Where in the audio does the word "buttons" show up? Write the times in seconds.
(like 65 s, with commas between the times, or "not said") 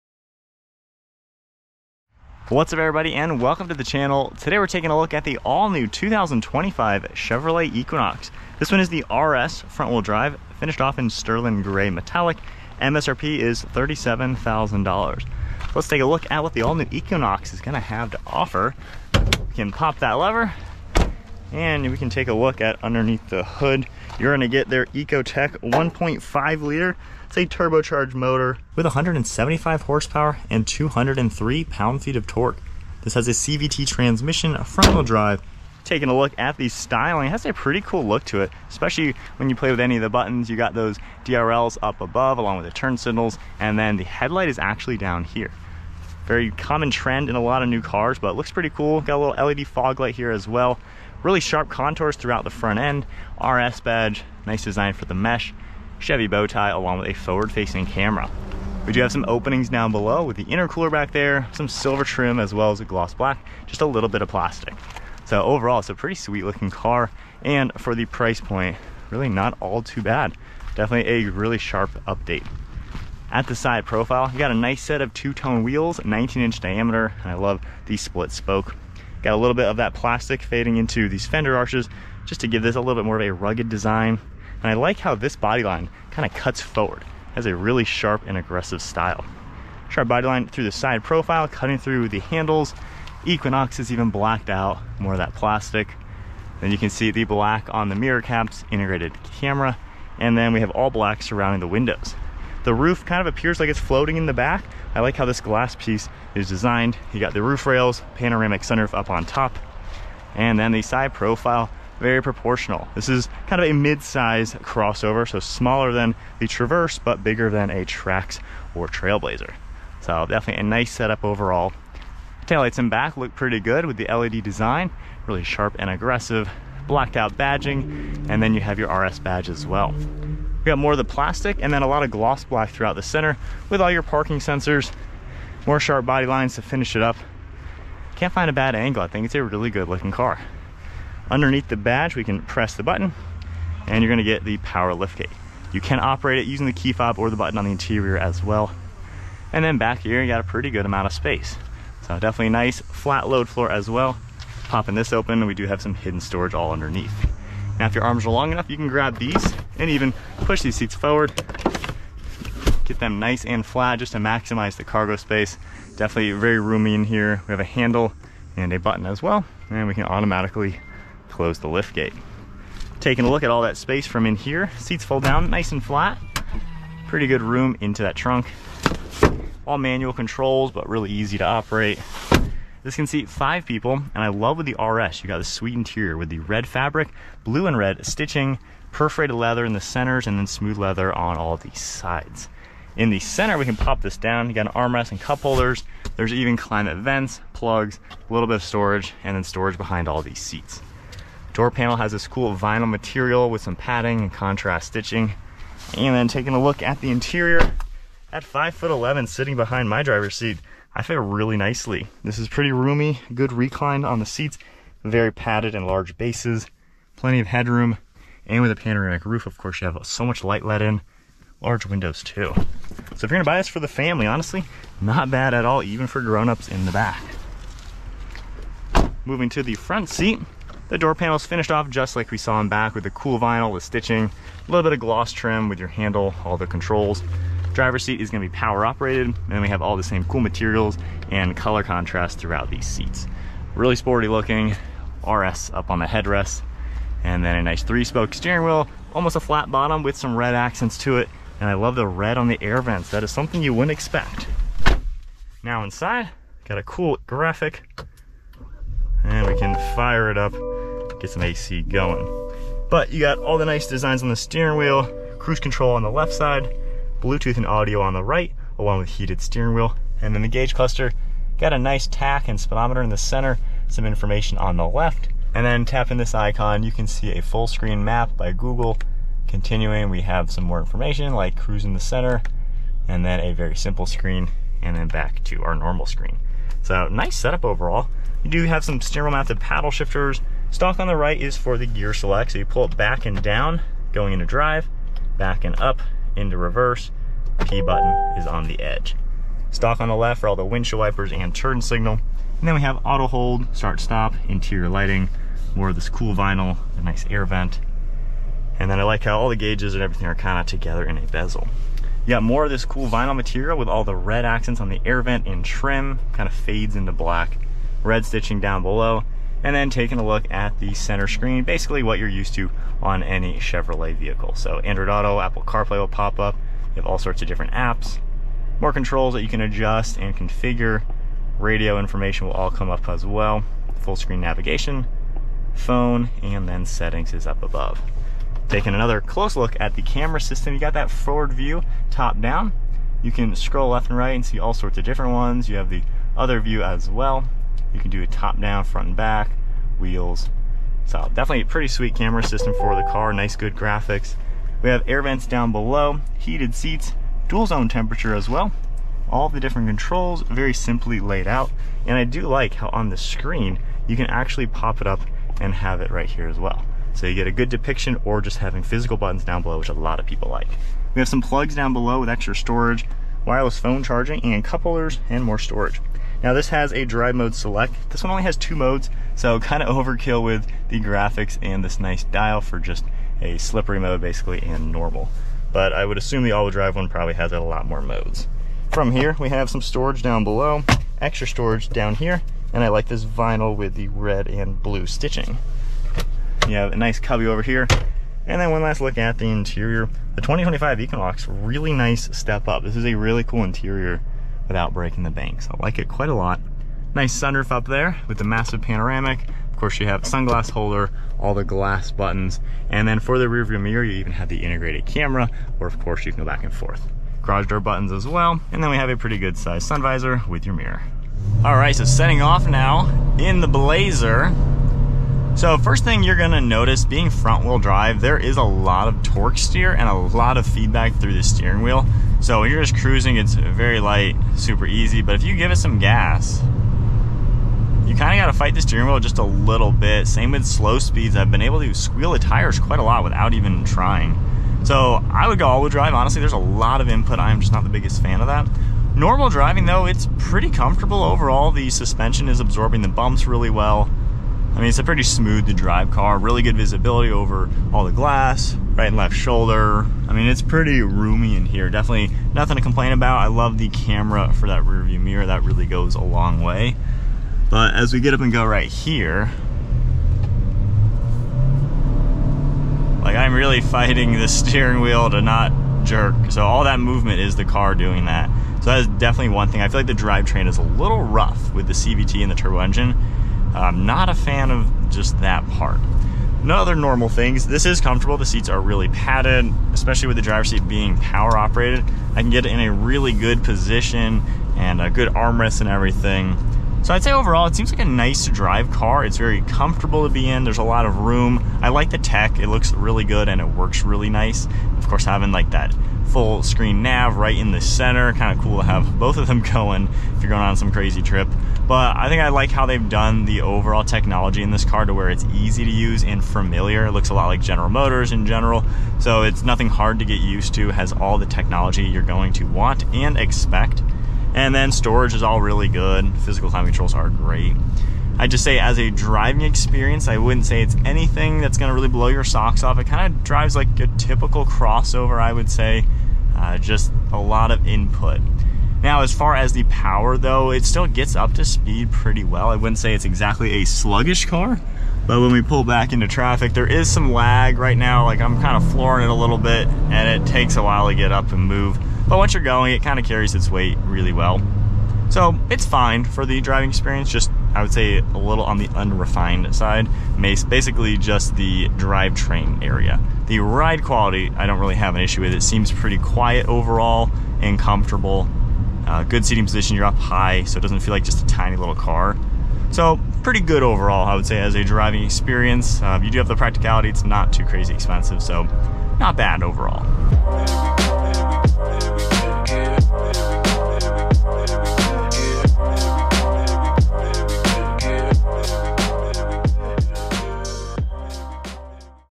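40 s, 142 s, 147 s, 168 s, 297 s, 369 s, 412 s, 417 s.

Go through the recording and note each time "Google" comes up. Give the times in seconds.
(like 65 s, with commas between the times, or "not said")
278 s.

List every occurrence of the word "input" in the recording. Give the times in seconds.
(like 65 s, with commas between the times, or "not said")
447 s, 537 s.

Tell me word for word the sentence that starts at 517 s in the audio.
It looks a lot like General Motors in general.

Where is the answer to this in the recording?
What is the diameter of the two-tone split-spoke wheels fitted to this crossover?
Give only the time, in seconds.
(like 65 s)
75 s.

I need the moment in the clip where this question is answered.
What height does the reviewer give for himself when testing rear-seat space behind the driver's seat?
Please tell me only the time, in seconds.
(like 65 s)
208 s.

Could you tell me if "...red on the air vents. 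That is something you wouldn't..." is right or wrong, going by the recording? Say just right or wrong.
right.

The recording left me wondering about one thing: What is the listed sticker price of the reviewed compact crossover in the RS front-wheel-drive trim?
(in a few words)
$37,000.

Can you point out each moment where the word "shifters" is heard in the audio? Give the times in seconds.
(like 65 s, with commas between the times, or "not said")
289 s.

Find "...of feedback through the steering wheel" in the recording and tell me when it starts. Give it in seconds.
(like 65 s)
430 s.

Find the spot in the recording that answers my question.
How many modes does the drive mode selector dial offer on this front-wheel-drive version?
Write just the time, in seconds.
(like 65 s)
378 s.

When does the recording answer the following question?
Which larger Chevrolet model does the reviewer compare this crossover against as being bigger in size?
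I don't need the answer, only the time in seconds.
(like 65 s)
116 s.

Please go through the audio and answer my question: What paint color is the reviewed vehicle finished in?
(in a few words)
sterling gray metallic.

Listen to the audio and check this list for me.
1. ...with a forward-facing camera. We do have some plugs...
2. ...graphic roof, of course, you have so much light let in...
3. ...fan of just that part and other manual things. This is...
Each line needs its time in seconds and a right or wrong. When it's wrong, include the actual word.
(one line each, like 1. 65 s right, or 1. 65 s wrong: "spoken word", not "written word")
1. 56 s wrong: "openings", not "plugs"
2. 218 s wrong: "panoramic", not "graphic"
3. 484 s wrong: "normal", not "manual".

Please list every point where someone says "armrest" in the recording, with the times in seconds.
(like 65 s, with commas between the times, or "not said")
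194 s, 495 s.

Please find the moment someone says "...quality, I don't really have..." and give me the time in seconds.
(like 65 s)
564 s.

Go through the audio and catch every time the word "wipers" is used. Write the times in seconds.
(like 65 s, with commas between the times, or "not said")
301 s.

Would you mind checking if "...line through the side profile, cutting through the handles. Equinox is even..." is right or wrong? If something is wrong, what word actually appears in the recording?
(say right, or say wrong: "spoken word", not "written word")
right.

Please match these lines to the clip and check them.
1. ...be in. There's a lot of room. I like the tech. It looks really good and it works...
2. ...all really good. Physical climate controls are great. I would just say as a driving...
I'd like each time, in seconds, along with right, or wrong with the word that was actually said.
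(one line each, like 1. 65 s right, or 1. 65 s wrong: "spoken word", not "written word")
1. 500 s right
2. 525 s right.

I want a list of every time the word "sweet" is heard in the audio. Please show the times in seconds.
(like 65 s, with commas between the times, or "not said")
66 s, 185 s, 351 s.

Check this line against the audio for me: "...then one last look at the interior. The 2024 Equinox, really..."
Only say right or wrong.
wrong.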